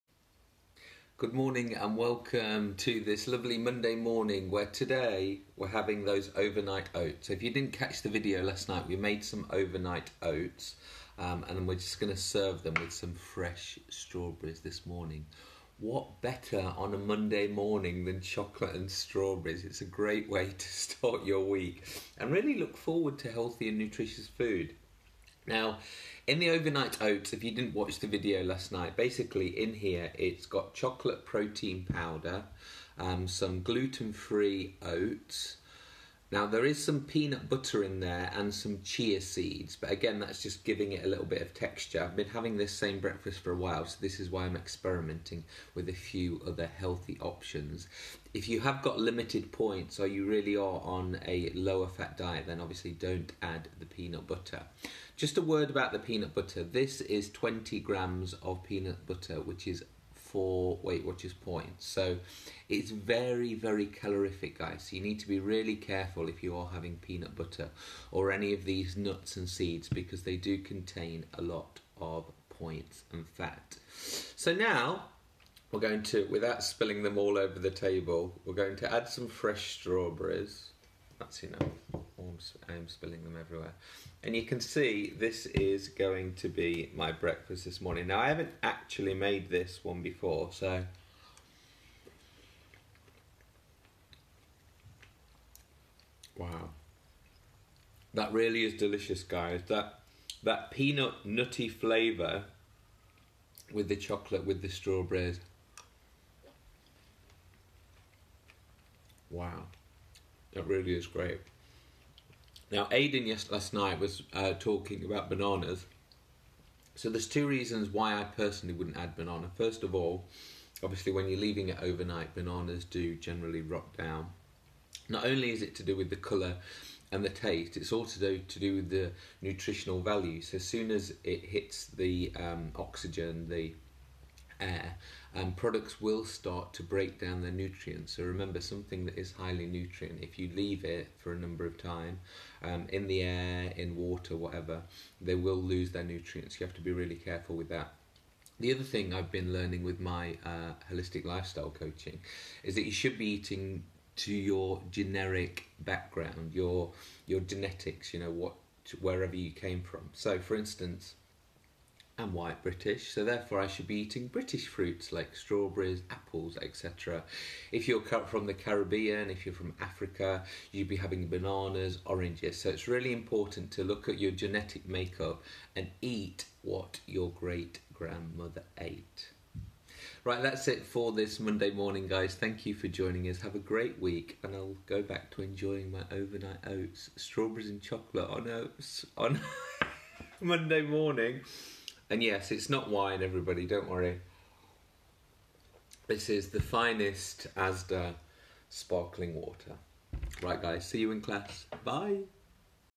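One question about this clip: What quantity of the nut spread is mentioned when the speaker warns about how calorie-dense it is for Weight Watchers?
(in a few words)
20 grams.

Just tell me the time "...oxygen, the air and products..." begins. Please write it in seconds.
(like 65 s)
132 s.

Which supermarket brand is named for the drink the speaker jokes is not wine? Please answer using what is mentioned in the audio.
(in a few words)
Asda.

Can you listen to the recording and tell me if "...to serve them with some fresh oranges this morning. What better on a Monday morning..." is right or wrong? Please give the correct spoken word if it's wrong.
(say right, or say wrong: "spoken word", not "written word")
wrong: "strawberries", not "oranges".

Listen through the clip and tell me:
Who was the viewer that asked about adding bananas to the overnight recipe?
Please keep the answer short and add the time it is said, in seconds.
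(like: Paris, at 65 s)
Aidan, at 112 s.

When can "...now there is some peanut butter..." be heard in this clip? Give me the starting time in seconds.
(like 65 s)
36 s.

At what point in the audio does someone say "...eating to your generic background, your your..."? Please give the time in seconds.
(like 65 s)
153 s.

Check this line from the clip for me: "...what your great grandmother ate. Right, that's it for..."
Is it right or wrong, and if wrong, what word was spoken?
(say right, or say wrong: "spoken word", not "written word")
right.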